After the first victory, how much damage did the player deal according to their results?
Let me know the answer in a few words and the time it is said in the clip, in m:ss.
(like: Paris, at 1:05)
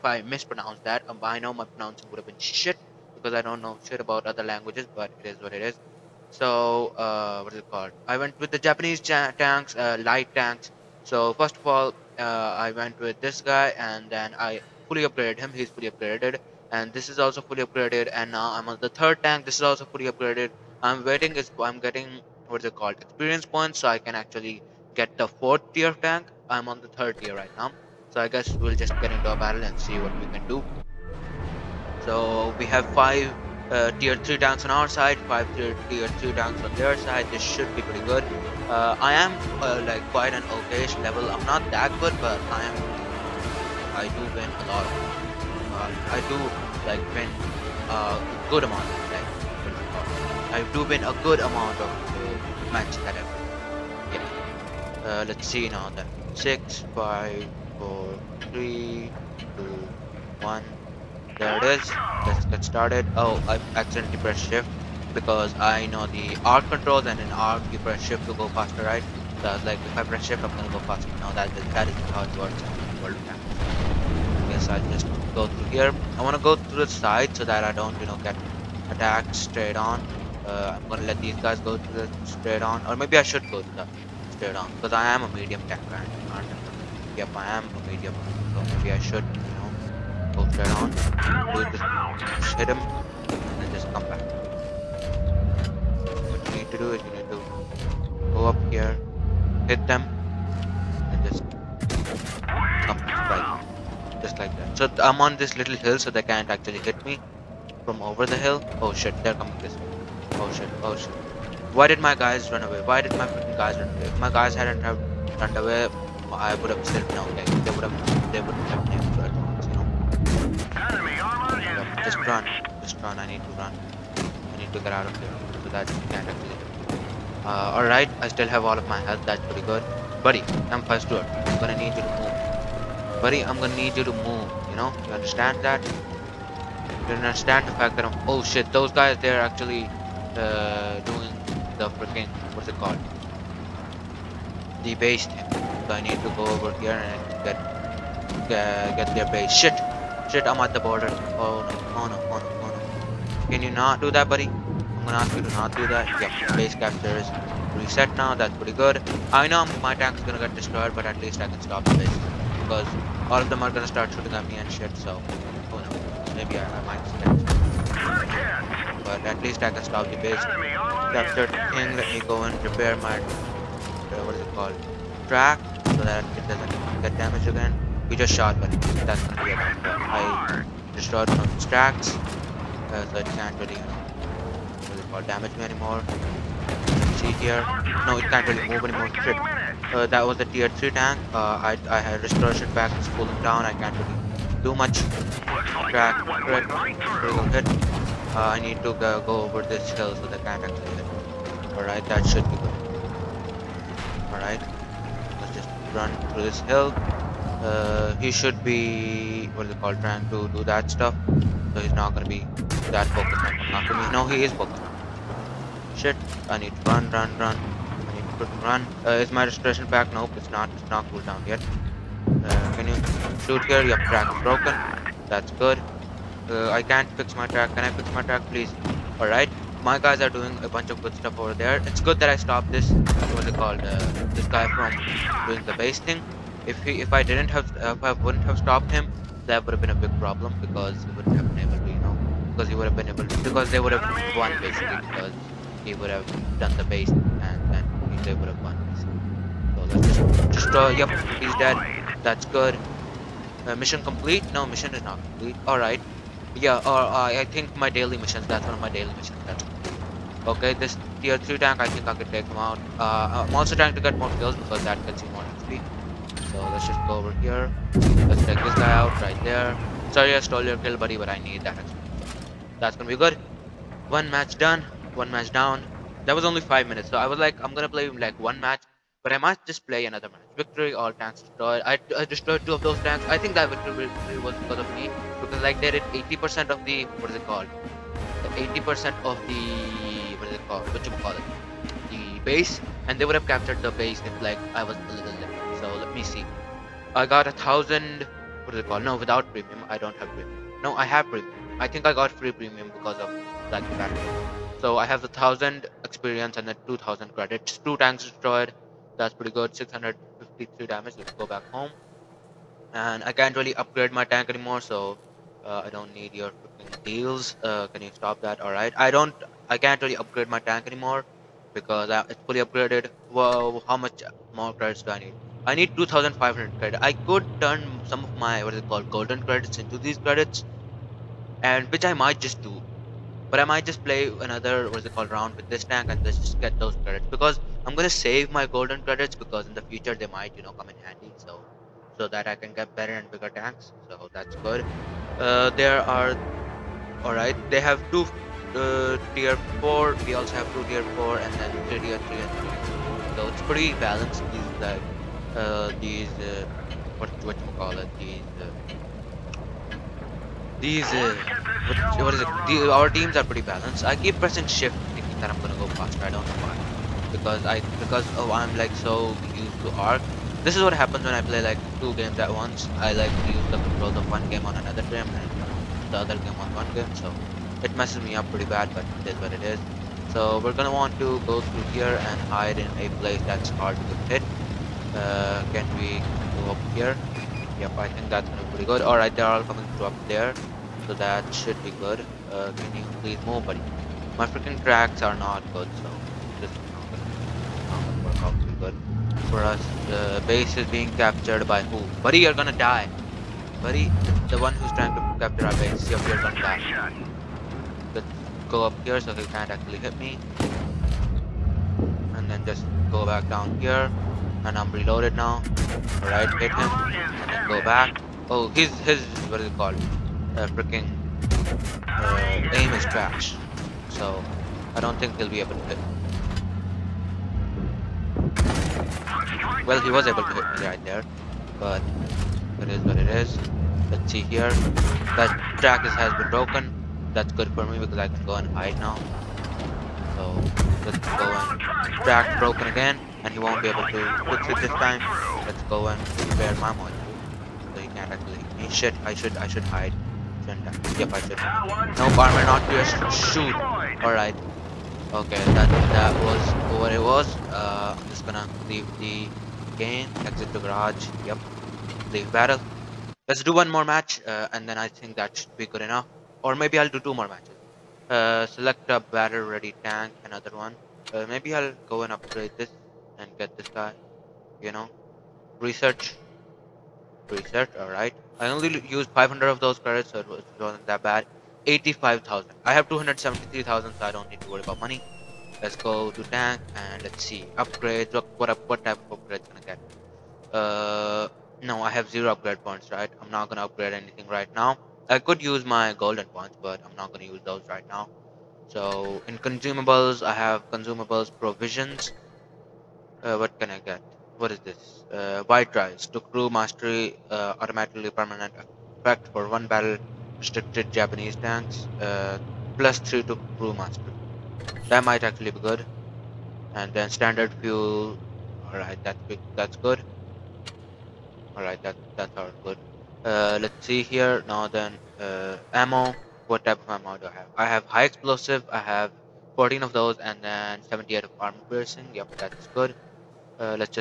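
653, at 5:09.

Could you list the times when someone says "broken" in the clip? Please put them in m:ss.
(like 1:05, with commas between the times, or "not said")
3:44, 7:16, 7:22.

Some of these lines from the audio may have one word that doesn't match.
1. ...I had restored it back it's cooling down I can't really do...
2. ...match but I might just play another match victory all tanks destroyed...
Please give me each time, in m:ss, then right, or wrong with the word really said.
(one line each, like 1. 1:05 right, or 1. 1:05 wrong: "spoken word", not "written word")
1. 3:11 right
2. 4:38 right.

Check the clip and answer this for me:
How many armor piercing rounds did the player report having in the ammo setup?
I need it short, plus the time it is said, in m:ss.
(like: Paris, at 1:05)
78, at 8:51.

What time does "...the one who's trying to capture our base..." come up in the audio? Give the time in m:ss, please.
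6:44.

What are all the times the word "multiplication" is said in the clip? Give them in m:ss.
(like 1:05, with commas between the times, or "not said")
not said.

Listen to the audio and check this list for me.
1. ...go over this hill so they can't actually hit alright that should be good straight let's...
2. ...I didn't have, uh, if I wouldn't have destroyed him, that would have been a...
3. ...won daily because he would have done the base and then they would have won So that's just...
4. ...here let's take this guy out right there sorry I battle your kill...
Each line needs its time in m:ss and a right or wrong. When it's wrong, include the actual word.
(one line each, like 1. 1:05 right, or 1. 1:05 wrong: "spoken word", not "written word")
1. 3:19 wrong: "alright", not "straight"
2. 3:57 wrong: "stopped", not "destroyed"
3. 4:04 wrong: "basically", not "daily"
4. 4:27 wrong: "stole", not "battle".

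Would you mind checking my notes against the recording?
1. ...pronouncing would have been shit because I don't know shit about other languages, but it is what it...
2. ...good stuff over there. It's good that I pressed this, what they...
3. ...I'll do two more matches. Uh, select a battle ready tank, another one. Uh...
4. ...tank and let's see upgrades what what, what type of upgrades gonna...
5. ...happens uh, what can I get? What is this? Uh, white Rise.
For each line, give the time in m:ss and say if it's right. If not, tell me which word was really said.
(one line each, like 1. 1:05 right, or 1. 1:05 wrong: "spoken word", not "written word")
1. 0:01 right
2. 3:51 wrong: "stopped", not "pressed"
3. 7:46 right
4. 8:06 right
5. 8:21 wrong: "provisions", not "happens".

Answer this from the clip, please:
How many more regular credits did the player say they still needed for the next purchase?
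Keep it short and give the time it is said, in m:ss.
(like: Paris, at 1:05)
2500, at 5:25.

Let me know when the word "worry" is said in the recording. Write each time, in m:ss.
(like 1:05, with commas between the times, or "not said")
8:04.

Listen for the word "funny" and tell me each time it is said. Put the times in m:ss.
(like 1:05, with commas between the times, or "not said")
not said.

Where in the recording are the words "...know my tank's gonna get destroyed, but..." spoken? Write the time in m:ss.
2:39.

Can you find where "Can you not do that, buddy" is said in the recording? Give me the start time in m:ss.
2:33.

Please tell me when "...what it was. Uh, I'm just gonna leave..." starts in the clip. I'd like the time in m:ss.
7:37.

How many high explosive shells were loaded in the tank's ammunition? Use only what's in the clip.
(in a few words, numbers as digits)
14.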